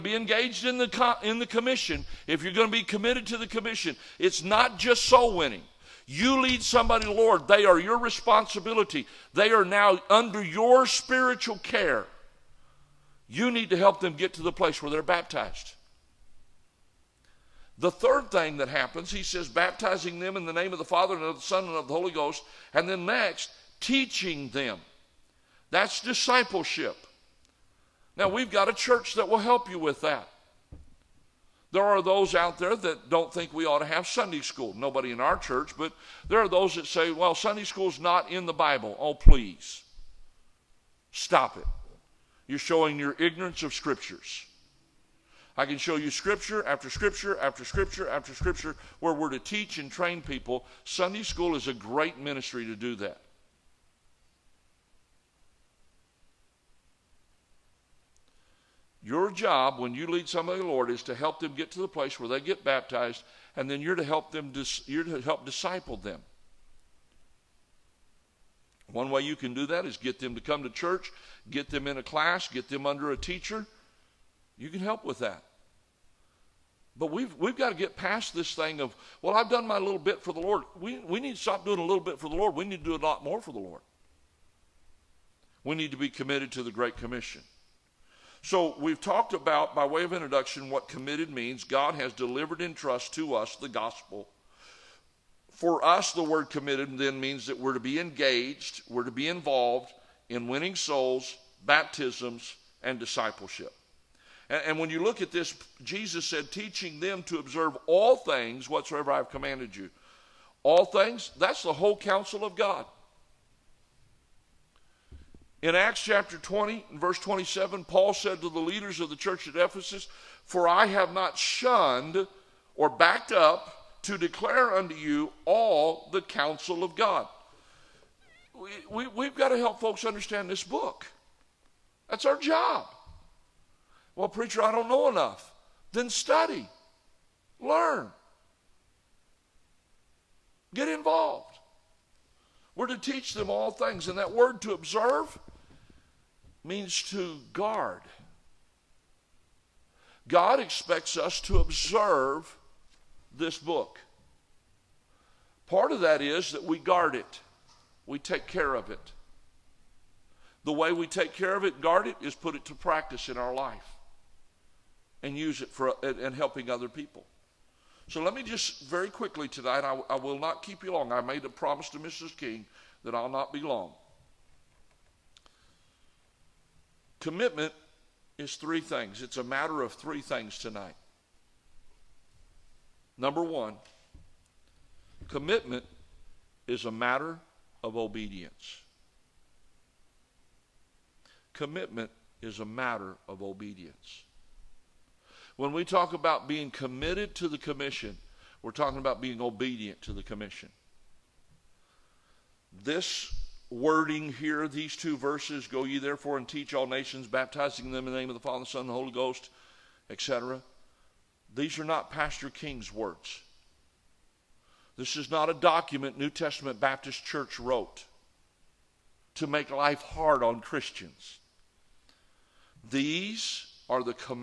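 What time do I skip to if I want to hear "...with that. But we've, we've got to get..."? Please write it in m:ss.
1:15.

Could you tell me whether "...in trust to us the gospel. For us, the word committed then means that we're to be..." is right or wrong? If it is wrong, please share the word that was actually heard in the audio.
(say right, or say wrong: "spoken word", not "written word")
right.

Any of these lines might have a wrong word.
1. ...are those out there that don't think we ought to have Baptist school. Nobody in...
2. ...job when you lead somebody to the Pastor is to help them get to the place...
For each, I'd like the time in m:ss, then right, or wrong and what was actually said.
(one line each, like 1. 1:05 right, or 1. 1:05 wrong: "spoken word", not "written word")
1. 0:31 wrong: "Sunday", not "Baptist"
2. 0:59 wrong: "Lord", not "Pastor".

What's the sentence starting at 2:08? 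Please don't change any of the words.
We, we, we've got to help folks understand this book.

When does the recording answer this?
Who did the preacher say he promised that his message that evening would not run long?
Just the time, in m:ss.
2:51.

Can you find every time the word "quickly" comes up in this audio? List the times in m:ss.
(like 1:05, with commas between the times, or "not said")
2:49.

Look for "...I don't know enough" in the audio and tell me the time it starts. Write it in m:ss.
2:14.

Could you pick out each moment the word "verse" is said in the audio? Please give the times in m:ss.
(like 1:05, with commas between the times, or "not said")
1:57, 3:25.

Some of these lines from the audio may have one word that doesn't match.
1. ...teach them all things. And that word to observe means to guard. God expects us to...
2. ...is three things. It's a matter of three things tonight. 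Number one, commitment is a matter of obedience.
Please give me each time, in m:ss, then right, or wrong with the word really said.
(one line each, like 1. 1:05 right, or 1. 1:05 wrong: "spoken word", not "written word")
1. 2:22 right
2. 2:58 right.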